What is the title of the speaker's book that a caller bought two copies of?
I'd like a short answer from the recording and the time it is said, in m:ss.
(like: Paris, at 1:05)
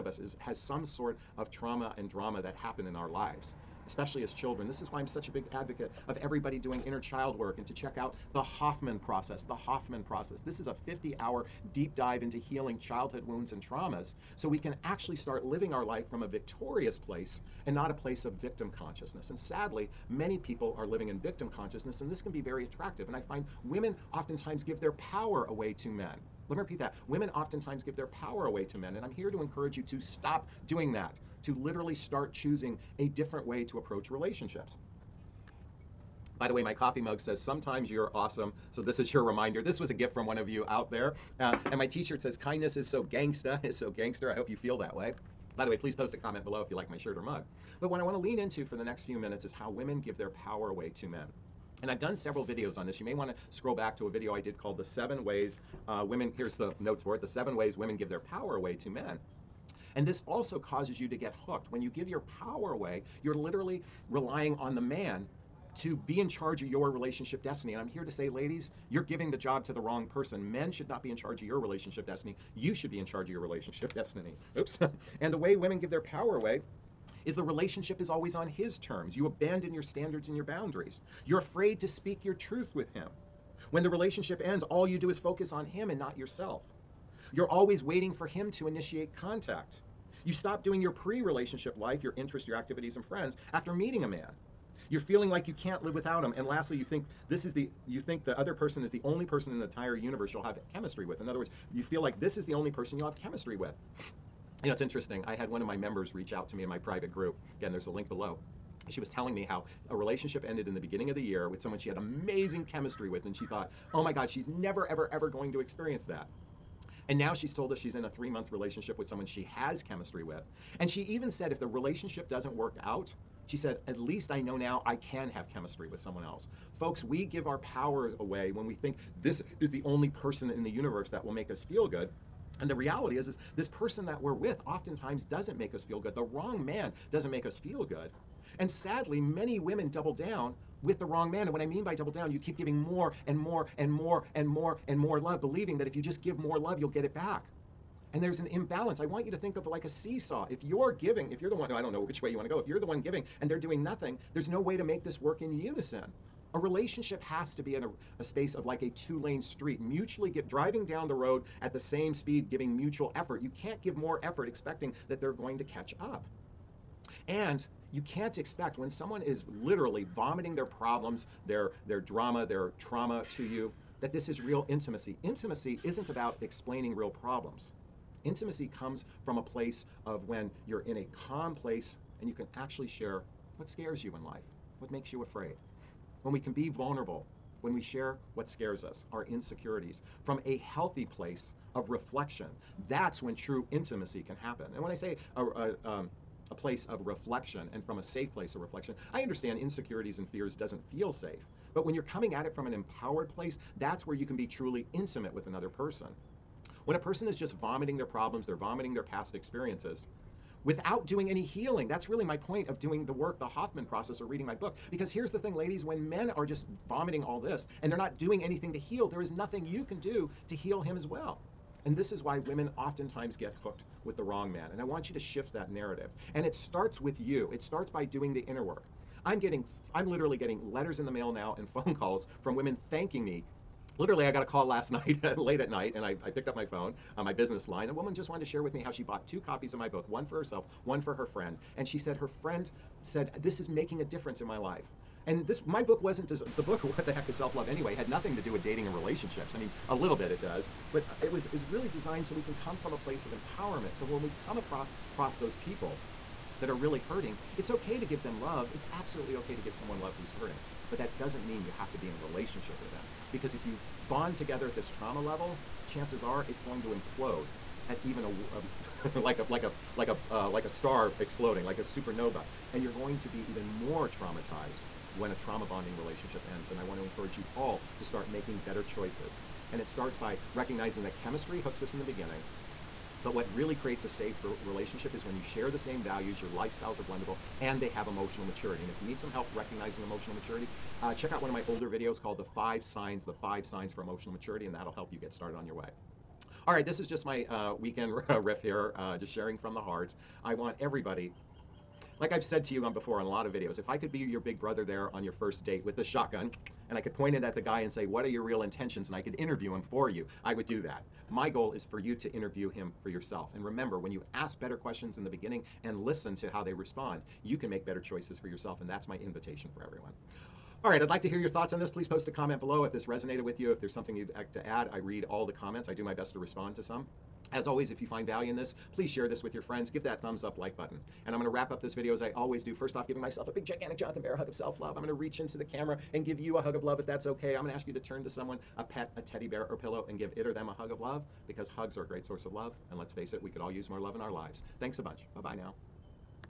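What the Heck Is Self-Love Anyway, at 4:06.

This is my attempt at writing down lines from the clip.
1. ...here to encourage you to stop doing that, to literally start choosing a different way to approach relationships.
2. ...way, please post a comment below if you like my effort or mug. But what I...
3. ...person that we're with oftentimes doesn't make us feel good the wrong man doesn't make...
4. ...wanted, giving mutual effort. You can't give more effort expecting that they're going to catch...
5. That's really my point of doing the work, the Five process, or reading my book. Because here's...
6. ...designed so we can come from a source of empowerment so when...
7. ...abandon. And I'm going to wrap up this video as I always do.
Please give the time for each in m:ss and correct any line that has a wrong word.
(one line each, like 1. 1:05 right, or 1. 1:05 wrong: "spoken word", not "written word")
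1. 0:29 right
2. 0:45 wrong: "shirt", not "effort"
3. 2:13 right
4. 2:42 wrong: "speed", not "wanted"
5. 3:31 wrong: "Hoffman", not "Five"
6. 4:11 wrong: "place", not "source"
7. 5:30 wrong: "button", not "abandon".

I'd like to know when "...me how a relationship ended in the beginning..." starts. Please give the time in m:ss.
1:49.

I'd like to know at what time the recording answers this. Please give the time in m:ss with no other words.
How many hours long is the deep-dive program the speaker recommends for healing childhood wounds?
0:10.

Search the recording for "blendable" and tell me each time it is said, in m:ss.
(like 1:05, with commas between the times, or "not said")
4:47.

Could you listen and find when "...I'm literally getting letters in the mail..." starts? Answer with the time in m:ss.
3:49.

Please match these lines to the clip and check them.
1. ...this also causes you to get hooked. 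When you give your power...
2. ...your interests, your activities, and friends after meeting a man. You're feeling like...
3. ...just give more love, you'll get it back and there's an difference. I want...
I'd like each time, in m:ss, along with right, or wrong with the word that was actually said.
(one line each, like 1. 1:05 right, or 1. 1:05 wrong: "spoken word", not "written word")
1. 1:00 right
2. 1:32 right
3. 2:26 wrong: "imbalance", not "difference".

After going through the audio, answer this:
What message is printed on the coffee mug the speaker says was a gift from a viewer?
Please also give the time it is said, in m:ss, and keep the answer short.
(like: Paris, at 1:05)
Sometimes you're awesome, at 0:37.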